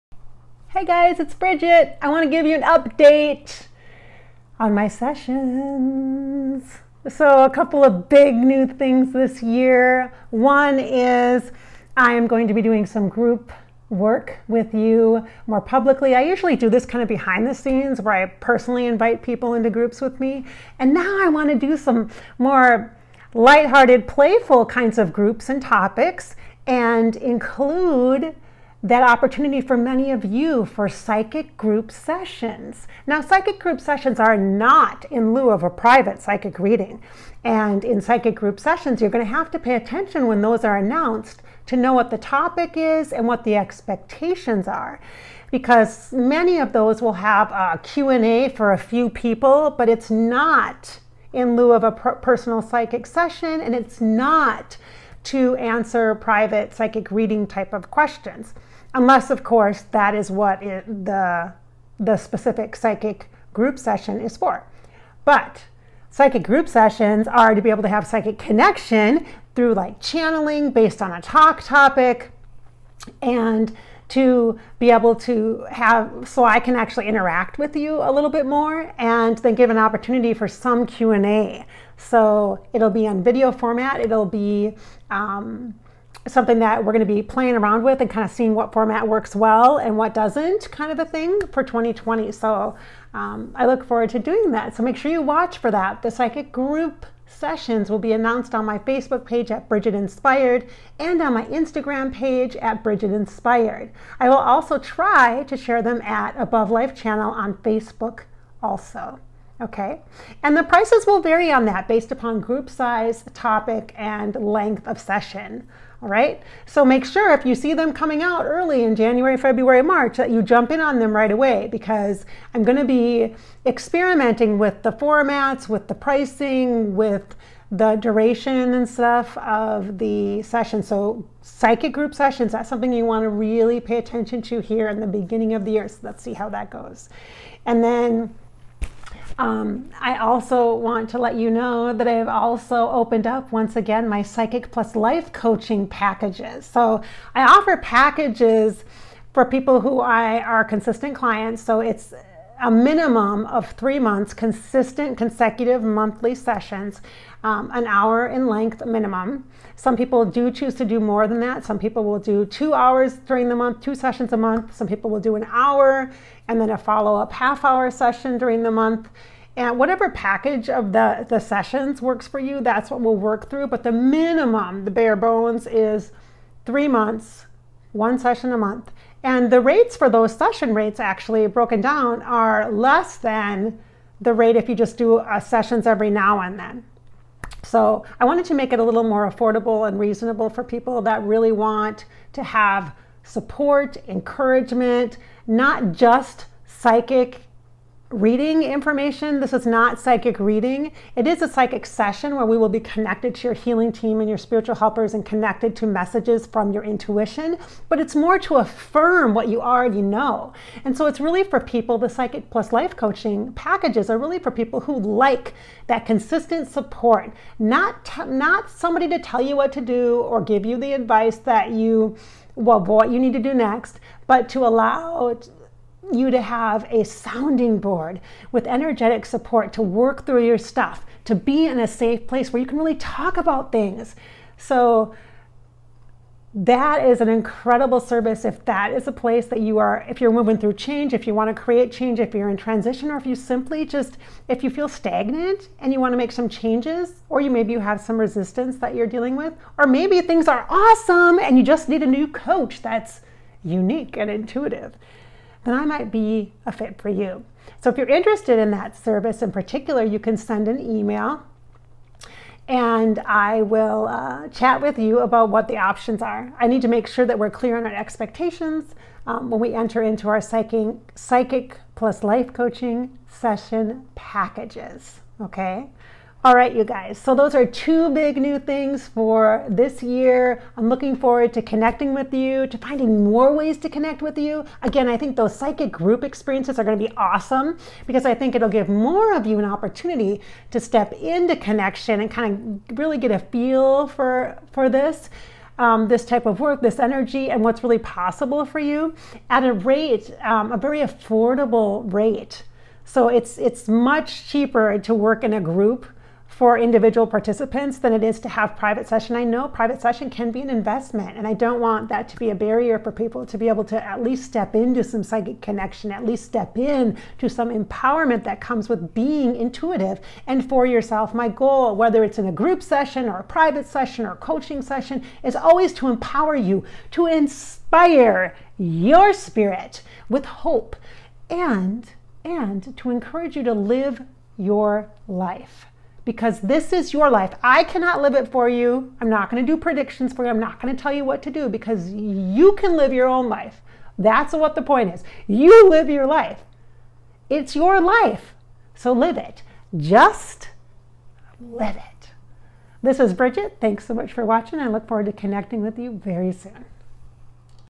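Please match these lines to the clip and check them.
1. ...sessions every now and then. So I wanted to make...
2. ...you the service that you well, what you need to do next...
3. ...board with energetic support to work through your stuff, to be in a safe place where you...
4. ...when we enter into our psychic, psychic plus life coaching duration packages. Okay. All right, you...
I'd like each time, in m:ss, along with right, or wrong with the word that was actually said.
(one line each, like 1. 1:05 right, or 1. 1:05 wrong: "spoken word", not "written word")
1. 3:05 right
2. 3:40 wrong: "advice", not "service"
3. 3:47 right
4. 4:29 wrong: "session", not "duration".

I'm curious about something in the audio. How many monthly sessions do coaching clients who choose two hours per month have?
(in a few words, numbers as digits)
2.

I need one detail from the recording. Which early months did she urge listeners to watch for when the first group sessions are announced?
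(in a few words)
January, February, March.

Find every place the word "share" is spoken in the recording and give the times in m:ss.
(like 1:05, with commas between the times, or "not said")
1:45.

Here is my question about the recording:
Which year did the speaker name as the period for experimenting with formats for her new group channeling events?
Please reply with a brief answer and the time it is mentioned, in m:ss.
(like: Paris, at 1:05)
2020, at 1:31.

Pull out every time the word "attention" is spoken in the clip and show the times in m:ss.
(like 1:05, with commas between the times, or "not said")
0:39, 2:13.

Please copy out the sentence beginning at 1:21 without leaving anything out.
So it'll be on video format.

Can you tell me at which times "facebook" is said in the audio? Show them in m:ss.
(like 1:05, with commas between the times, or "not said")
1:38, 1:47.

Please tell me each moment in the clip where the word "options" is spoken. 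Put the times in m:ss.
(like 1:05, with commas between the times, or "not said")
4:25.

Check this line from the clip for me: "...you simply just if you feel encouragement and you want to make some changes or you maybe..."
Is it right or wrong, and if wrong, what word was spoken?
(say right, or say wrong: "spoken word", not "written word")
wrong: "stagnant", not "encouragement".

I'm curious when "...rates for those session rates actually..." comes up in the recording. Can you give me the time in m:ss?
2:59.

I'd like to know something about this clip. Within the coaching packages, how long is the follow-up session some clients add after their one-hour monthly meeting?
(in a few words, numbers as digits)
Half hour.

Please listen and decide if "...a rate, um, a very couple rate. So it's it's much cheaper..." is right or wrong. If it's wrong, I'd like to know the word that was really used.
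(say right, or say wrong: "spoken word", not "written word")
wrong: "affordable", not "couple".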